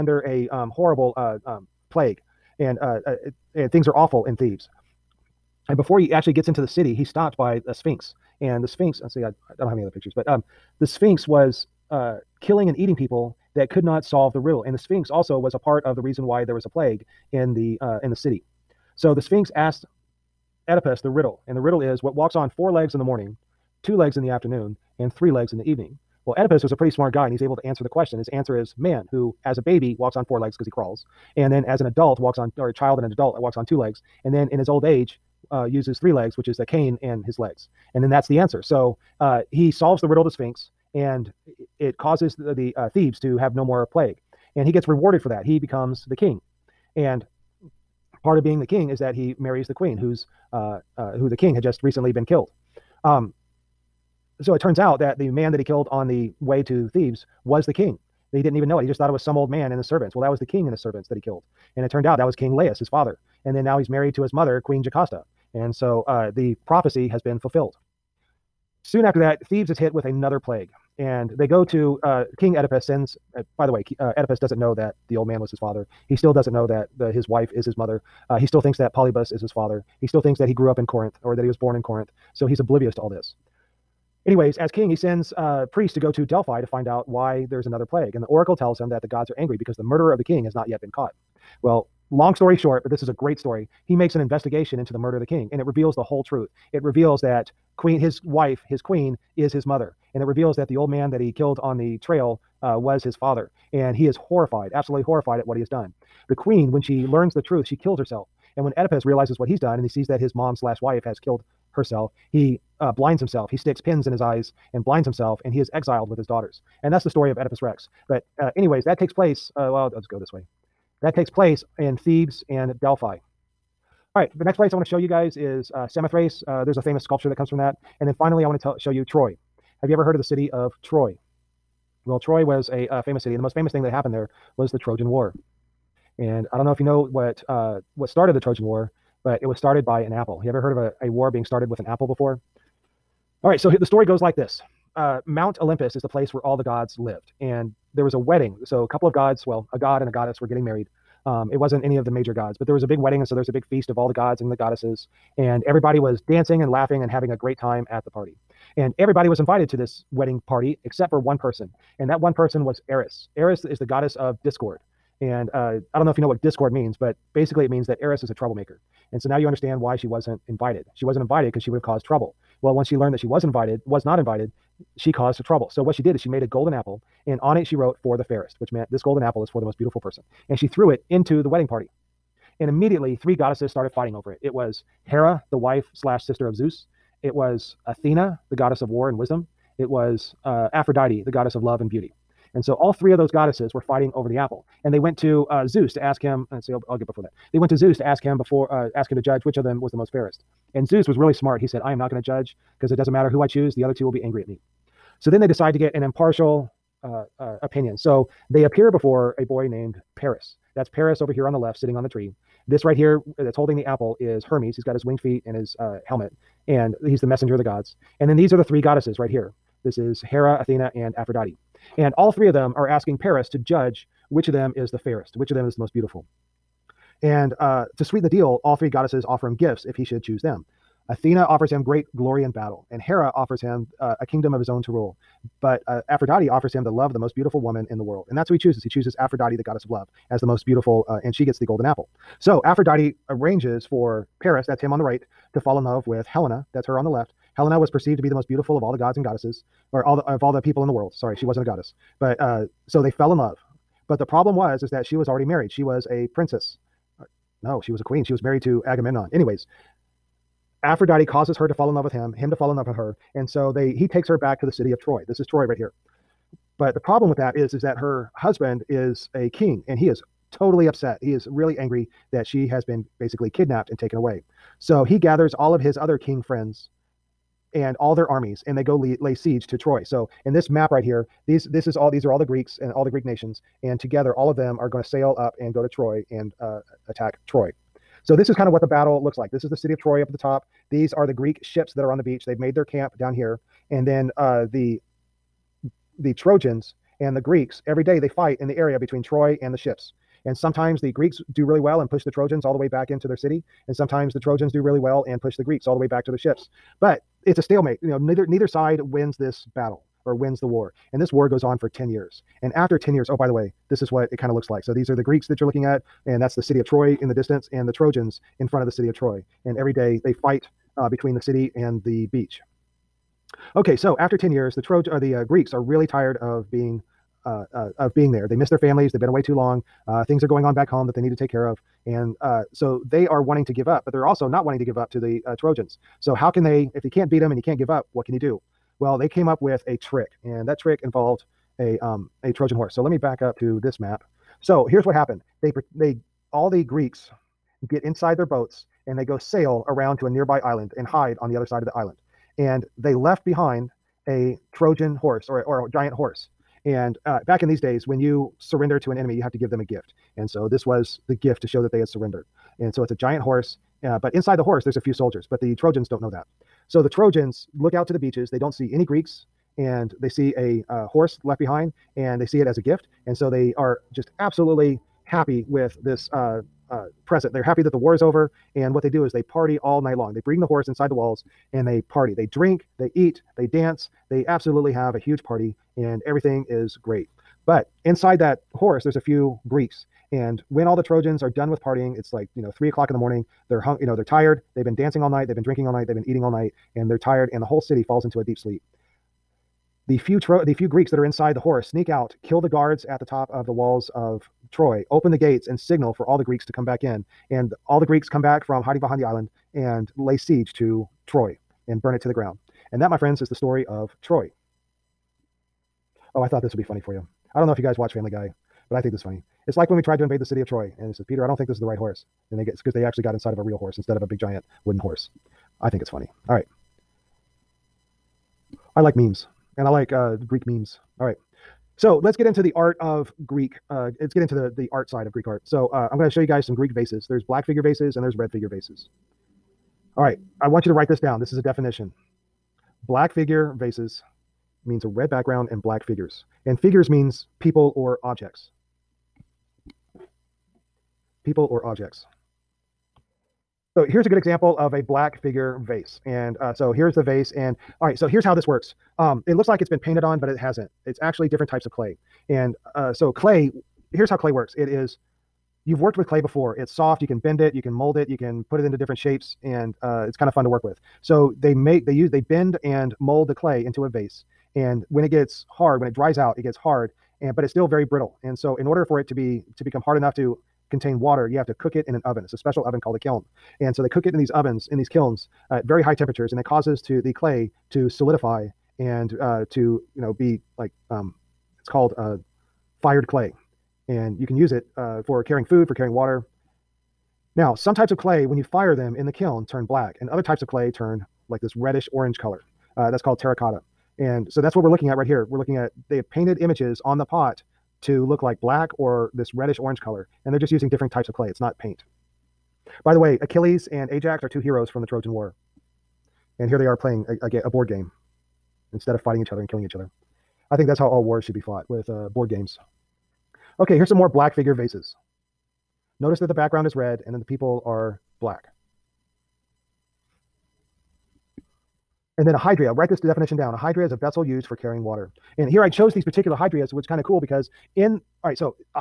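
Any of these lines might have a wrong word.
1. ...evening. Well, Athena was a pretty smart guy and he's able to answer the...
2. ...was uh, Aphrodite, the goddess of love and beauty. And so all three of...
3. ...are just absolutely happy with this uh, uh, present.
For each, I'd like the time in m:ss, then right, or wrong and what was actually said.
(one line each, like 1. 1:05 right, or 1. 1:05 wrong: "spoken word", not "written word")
1. 0:25 wrong: "Oedipus", not "Athena"
2. 3:09 right
3. 6:13 right.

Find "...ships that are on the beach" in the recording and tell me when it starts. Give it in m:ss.
4:51.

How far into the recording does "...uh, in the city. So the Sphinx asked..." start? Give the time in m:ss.
0:17.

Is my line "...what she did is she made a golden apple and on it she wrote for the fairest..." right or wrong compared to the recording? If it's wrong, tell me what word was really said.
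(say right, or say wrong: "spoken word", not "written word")
right.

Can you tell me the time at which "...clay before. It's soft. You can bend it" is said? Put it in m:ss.
7:46.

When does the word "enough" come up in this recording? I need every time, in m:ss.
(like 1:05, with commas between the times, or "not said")
8:00.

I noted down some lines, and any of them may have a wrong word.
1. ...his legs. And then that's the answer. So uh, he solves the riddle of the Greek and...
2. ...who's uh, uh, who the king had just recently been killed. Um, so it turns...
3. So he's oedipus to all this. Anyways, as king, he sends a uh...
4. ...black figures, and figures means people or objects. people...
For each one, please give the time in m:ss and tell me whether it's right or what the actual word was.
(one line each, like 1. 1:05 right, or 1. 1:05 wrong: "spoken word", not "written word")
1. 0:37 wrong: "Sphinx", not "Greek"
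2. 0:49 right
3. 1:22 wrong: "oblivious", not "oedipus"
4. 7:25 right.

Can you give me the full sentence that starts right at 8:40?
I think that's how all wars should be fought with uh, board games.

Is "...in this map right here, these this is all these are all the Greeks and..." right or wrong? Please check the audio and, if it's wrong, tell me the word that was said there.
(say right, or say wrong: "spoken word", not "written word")
right.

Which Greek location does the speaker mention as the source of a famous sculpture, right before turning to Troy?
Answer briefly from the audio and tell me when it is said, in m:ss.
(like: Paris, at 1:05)
Samothrace, at 2:05.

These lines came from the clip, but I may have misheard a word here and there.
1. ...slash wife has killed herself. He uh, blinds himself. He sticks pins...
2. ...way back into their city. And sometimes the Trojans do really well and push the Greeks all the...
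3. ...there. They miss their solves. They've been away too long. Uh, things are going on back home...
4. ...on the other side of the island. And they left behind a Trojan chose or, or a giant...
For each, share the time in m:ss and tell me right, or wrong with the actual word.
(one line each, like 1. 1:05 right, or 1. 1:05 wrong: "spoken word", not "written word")
1. 1:50 right
2. 5:02 right
3. 5:28 wrong: "families", not "solves"
4. 5:51 wrong: "horse", not "chose".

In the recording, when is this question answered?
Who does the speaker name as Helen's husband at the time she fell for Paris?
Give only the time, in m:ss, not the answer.
4:18.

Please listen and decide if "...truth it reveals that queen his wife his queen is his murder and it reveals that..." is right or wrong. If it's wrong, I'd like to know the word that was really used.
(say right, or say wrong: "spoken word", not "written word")
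wrong: "mother", not "murder".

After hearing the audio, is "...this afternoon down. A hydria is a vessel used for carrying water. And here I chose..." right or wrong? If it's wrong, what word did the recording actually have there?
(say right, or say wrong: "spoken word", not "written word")
wrong: "definition", not "afternoon".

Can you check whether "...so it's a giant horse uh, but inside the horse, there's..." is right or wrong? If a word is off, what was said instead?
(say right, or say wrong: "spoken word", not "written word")
right.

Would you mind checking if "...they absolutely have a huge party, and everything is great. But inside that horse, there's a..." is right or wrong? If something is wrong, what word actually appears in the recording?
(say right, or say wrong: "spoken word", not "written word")
right.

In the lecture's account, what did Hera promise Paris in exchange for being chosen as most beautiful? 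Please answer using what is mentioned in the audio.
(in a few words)
a kingdom.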